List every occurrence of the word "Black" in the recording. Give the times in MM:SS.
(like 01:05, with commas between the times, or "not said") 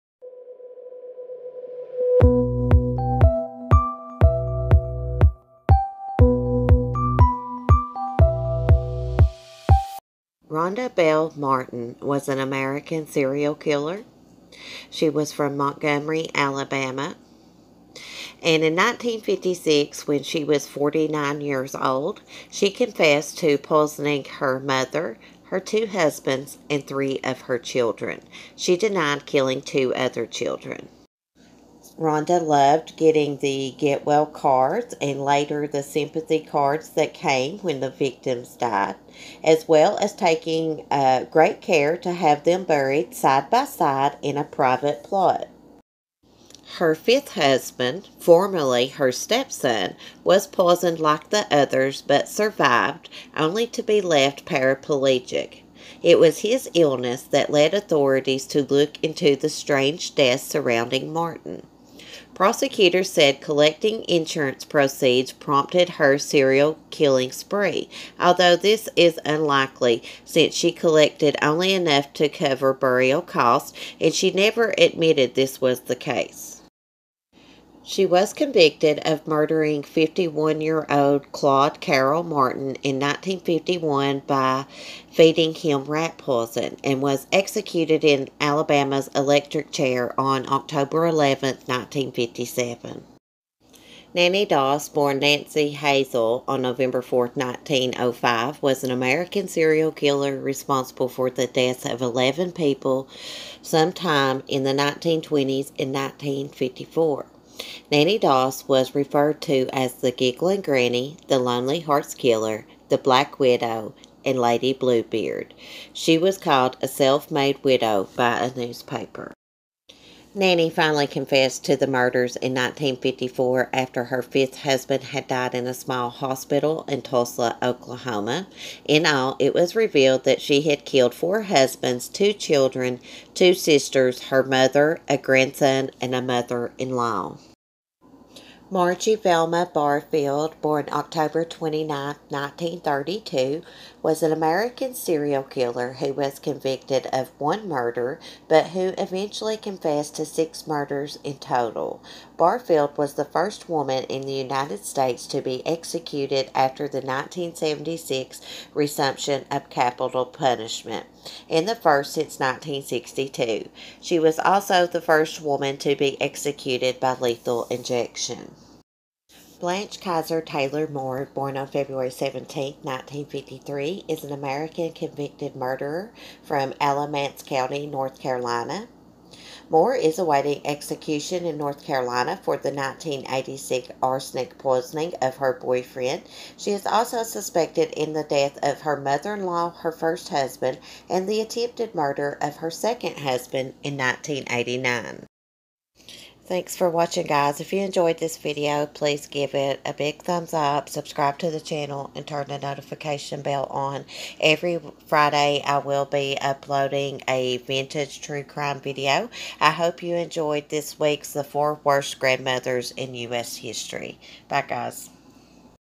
01:52.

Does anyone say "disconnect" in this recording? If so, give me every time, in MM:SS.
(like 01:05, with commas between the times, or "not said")
not said.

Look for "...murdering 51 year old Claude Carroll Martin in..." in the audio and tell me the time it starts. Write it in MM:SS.
01:19.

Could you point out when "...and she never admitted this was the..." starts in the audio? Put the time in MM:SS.
01:13.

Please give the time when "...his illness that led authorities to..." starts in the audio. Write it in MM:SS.
00:56.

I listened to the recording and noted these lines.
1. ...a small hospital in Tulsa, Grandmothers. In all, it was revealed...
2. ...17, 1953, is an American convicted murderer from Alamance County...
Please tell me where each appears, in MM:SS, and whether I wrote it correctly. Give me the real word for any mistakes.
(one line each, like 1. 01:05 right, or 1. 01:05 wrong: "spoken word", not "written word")
1. 02:05 wrong: "Oklahoma", not "Grandmothers"
2. 02:52 right.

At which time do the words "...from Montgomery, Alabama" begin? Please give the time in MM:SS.
00:15.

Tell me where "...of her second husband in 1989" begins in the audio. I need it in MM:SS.
03:12.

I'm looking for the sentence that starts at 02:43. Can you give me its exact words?
She was also the first woman to be executed by lethal injection.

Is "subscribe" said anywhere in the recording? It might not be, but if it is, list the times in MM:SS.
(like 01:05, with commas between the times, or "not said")
03:20.